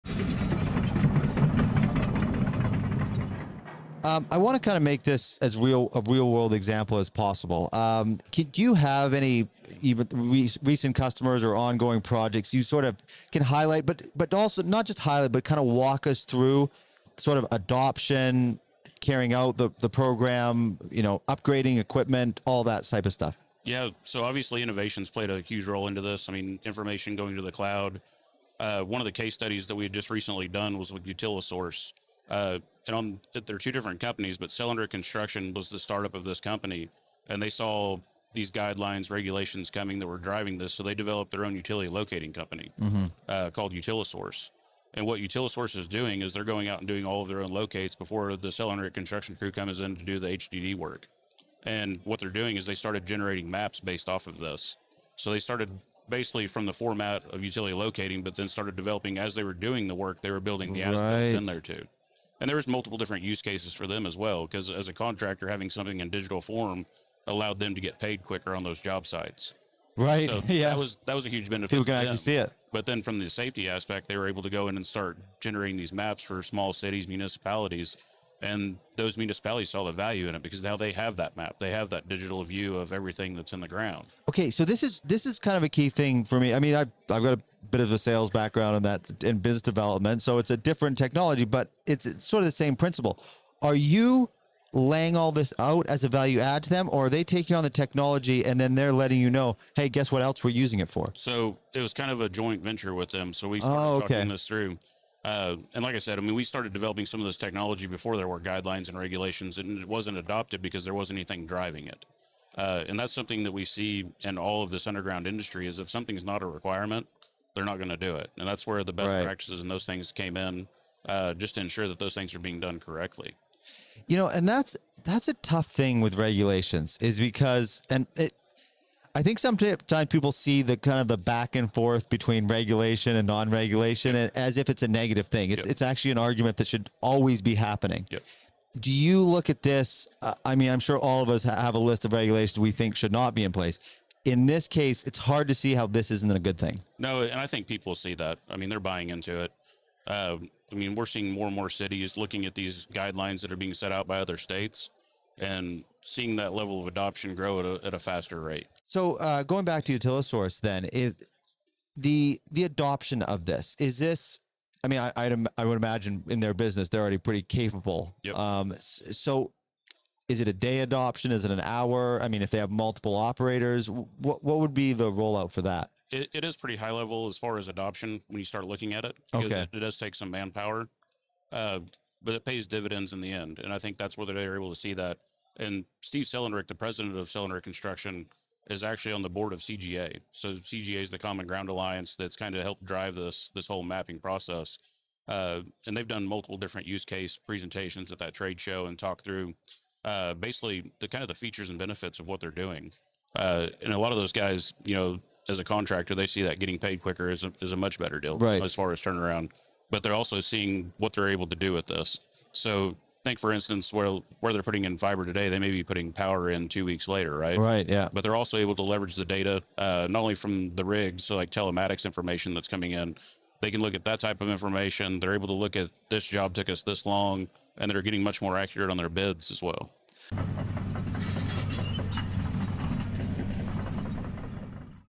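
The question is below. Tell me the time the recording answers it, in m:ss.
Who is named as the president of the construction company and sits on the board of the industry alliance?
3:06.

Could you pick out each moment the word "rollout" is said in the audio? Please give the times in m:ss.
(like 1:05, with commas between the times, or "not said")
2:55.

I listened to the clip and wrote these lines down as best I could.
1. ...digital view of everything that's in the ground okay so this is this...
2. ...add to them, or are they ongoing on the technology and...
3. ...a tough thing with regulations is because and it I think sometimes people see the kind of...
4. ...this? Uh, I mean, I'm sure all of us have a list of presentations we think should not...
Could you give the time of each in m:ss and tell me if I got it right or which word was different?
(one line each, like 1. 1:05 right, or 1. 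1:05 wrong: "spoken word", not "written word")
1. 1:22 right
2. 1:36 wrong: "taking", not "ongoing"
3. 2:05 right
4. 2:19 wrong: "regulations", not "presentations".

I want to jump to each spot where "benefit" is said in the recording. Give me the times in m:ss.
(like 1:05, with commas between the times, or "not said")
1:11, 3:21.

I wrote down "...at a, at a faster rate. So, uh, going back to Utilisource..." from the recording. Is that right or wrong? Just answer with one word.
right.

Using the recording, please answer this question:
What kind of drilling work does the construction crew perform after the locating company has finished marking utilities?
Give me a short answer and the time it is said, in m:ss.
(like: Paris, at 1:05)
HDD, at 0:50.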